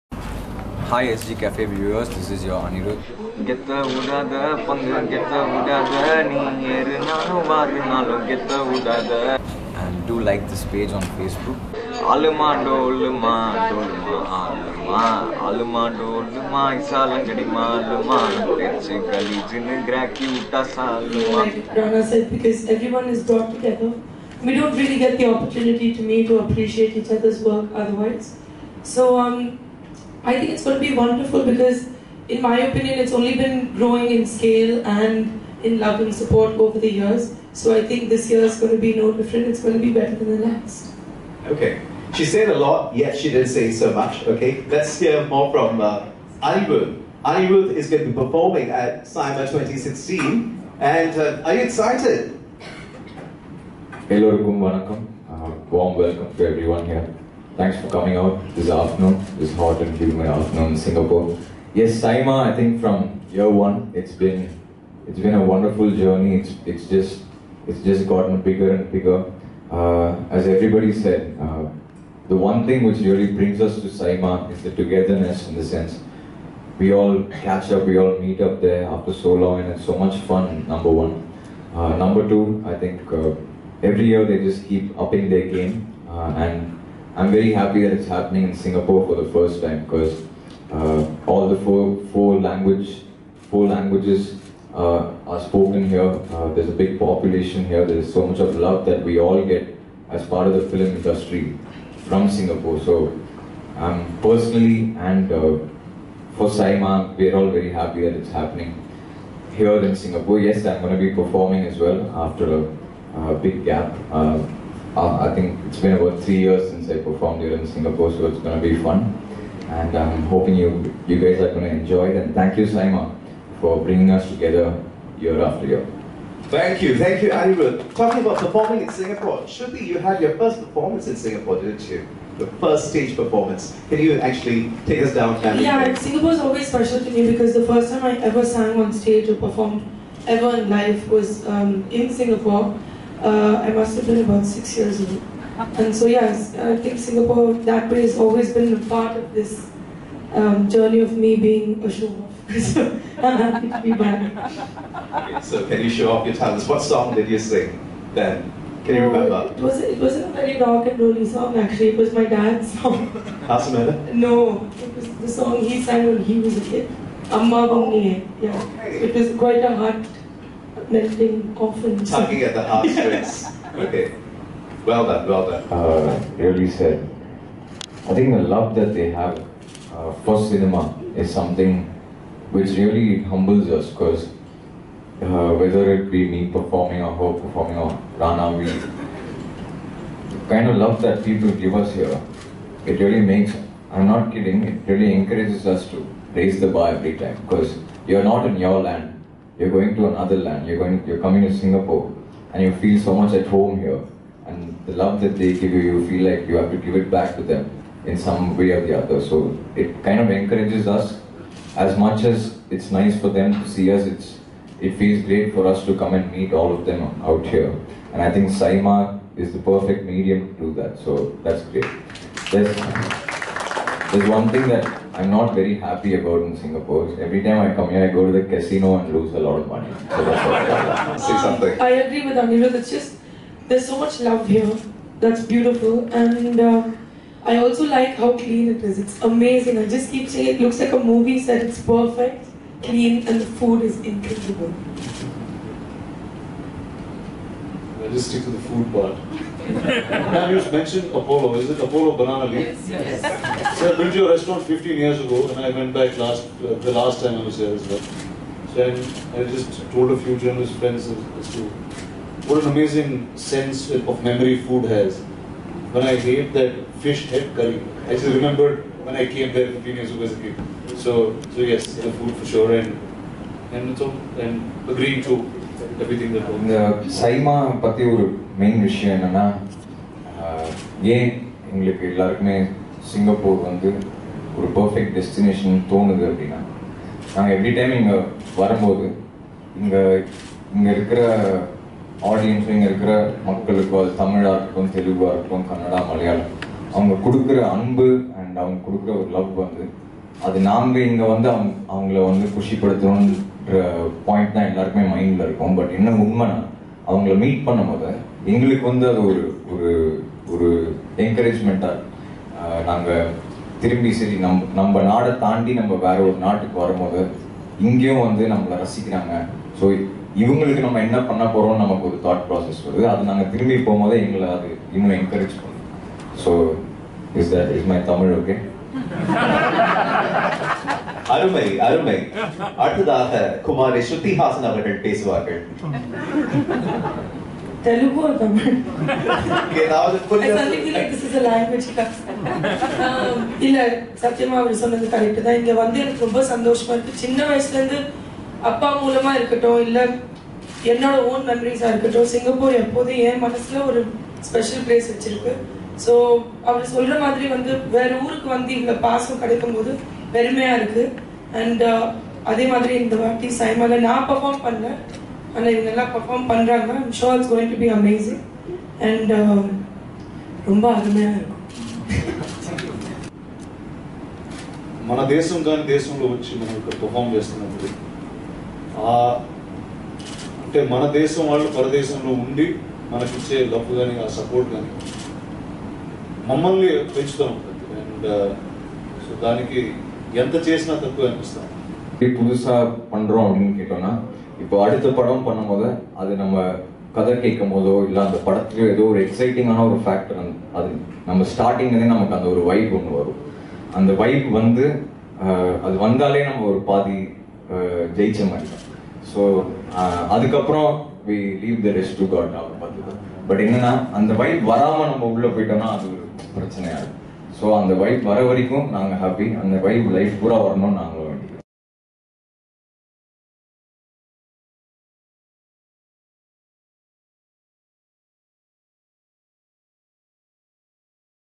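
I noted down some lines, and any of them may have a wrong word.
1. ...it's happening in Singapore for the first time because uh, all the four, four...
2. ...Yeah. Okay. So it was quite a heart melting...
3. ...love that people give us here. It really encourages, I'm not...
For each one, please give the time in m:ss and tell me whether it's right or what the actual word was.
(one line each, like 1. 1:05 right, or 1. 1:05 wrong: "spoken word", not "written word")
1. 1:27 right
2. 2:48 right
3. 3:10 wrong: "makes", not "encourages".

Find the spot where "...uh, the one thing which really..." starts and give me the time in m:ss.
1:11.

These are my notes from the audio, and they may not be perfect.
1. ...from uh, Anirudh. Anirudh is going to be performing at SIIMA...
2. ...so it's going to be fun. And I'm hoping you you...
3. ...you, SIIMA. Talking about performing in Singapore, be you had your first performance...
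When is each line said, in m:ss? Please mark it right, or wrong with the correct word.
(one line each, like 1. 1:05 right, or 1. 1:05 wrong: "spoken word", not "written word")
1. 0:45 right
2. 1:58 right
3. 2:07 wrong: "Anirudh", not "SIIMA".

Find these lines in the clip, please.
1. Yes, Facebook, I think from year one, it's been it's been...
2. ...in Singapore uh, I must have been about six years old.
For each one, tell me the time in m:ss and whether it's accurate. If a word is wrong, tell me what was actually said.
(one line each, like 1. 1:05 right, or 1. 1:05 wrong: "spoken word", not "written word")
1. 1:01 wrong: "SIIMA", not "Facebook"
2. 2:21 right.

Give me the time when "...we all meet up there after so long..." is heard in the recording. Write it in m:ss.
1:17.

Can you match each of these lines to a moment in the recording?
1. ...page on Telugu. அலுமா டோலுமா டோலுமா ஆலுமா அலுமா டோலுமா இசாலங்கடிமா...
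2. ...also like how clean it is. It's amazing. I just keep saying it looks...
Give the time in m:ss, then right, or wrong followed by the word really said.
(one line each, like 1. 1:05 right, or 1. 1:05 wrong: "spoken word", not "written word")
1. 0:10 wrong: "Facebook", not "Telugu"
2. 3:57 right.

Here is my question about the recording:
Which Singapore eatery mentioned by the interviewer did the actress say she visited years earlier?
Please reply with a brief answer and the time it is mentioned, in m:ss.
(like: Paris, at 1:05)
Apollo Banana Leaf, at 4:11.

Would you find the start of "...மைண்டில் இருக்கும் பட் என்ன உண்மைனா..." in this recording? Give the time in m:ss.
5:05.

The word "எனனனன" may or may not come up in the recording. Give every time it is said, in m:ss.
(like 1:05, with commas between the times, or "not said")
4:39, 6:53.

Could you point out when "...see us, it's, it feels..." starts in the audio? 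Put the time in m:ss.
3:33.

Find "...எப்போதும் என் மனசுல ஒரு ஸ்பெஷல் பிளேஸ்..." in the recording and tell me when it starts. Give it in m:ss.
5:52.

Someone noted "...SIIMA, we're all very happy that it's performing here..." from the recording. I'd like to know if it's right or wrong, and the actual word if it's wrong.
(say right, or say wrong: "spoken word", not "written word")
wrong: "happening", not "performing".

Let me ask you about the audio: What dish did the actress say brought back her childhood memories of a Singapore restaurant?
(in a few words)
fish head curry.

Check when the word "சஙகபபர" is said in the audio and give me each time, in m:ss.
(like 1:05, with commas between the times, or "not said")
4:43, 5:52.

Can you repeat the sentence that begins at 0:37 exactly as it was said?
So I think this year is going to be no different.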